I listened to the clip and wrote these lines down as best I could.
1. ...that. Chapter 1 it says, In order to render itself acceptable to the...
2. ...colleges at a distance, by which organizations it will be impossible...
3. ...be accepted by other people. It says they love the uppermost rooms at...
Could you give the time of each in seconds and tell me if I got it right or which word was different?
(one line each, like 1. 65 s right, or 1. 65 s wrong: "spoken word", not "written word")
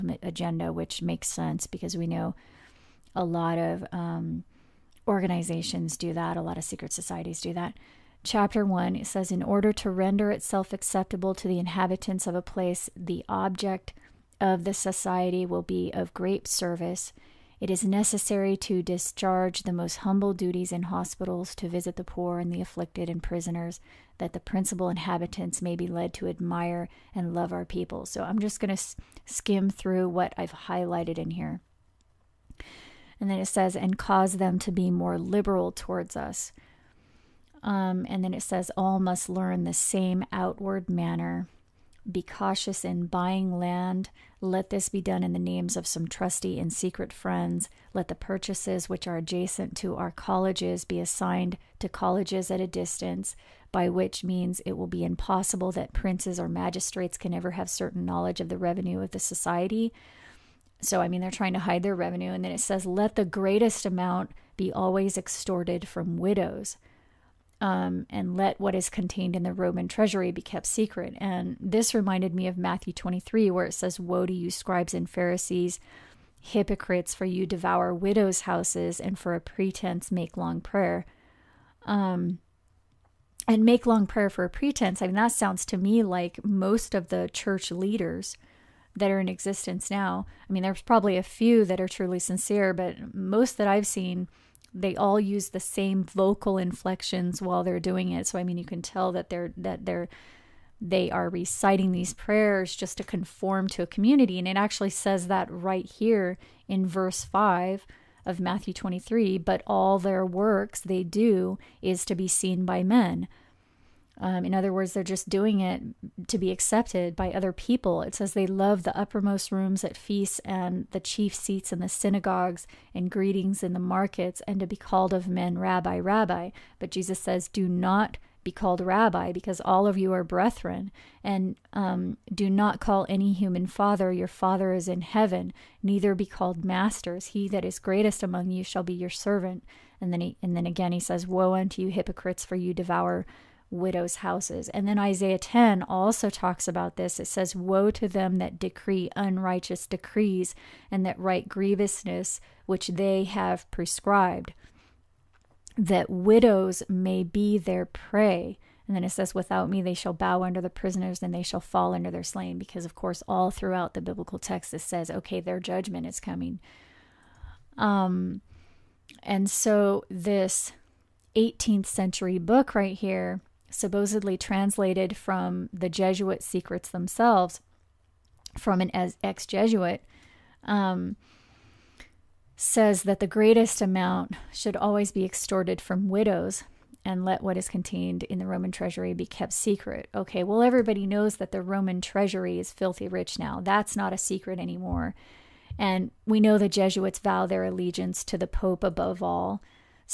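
1. 7 s right
2. 51 s wrong: "means", not "organizations"
3. 116 s right.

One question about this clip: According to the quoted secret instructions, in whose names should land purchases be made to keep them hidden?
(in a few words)
Trusty and secret friends.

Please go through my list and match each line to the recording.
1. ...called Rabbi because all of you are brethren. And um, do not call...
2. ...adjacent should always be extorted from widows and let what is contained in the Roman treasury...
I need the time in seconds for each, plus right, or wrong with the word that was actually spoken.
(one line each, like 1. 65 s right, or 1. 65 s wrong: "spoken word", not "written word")
1. 128 s right
2. 183 s wrong: "amount", not "adjacent".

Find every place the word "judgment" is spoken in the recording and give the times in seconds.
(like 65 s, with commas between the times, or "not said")
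165 s.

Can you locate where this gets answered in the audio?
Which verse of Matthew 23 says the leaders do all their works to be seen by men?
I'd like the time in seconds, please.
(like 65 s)
106 s.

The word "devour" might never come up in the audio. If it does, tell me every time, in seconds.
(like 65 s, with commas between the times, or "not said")
77 s, 142 s.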